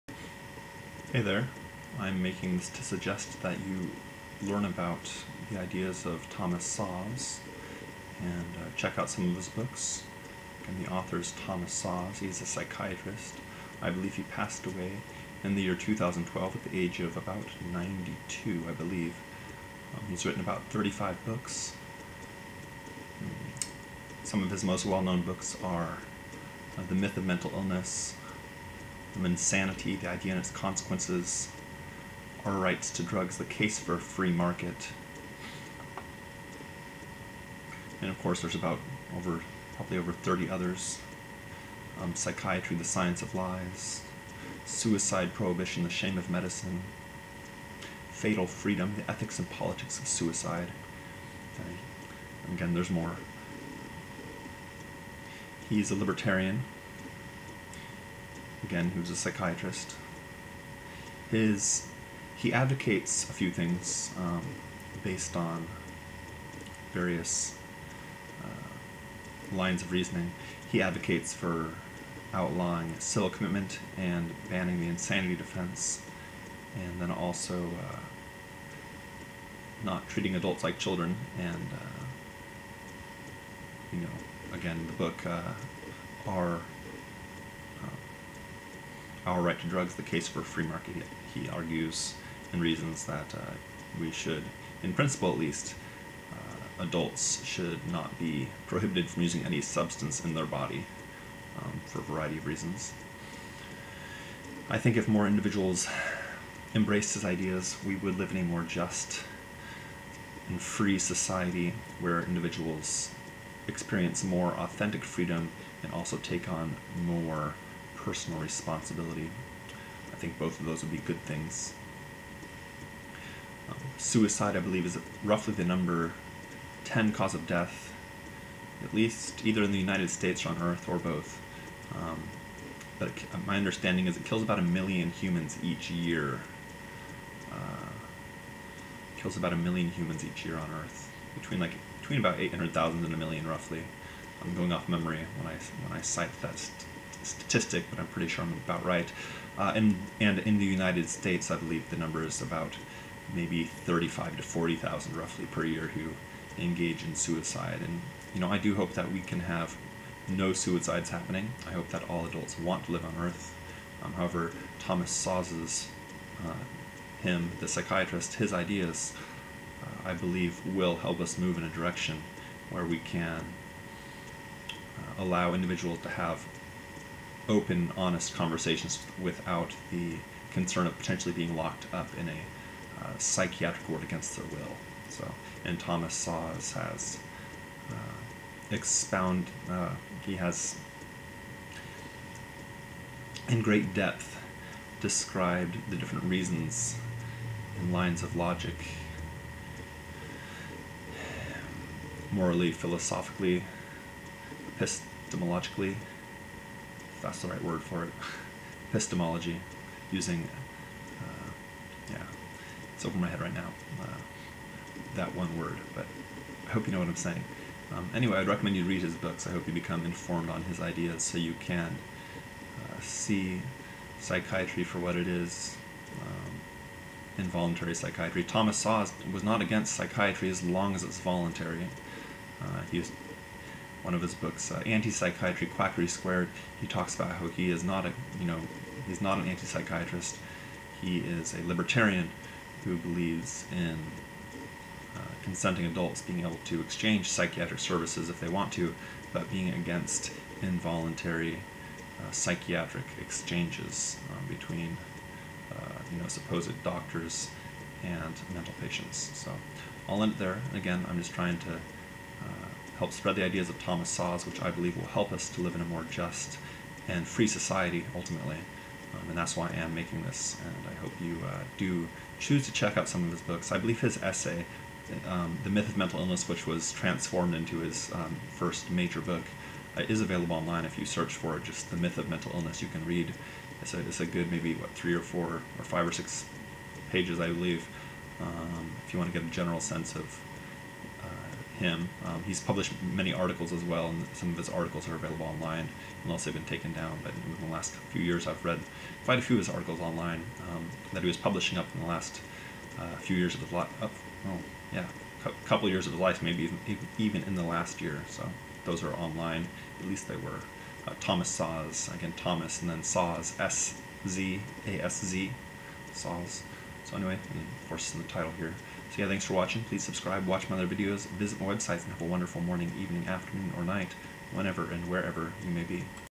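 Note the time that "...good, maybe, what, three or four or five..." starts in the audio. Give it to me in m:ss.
4:44.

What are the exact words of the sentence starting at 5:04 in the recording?
Oh, yeah, a couple years of his life, maybe even, even in the last year.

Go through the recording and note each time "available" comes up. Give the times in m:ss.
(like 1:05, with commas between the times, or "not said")
4:40, 4:55.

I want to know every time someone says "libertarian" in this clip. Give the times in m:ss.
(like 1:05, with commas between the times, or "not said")
0:55, 4:01.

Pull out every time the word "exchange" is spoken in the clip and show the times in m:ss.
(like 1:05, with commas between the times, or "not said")
4:06, 4:13.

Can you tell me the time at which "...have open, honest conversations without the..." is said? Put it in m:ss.
2:56.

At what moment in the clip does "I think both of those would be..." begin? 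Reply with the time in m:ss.
2:00.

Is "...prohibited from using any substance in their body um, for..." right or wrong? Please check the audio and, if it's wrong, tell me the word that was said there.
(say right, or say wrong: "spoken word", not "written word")
right.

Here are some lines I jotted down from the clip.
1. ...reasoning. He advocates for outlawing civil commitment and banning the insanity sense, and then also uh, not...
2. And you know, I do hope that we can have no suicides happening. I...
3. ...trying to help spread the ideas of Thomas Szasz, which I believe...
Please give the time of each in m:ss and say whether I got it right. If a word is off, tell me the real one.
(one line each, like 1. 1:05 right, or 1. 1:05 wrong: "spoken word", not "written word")
1. 1:09 wrong: "defense", not "sense"
2. 2:37 right
3. 4:21 right.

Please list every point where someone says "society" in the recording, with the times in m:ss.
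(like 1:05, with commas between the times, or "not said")
1:50, 4:27.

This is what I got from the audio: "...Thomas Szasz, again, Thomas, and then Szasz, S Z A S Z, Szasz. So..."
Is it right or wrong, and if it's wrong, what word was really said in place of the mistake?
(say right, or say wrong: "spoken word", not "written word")
right.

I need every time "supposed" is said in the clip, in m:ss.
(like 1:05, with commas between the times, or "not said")
4:16.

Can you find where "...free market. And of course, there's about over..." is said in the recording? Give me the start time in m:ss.
0:33.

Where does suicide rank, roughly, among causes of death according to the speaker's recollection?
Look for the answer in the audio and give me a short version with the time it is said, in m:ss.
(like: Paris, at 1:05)
number 10, at 2:05.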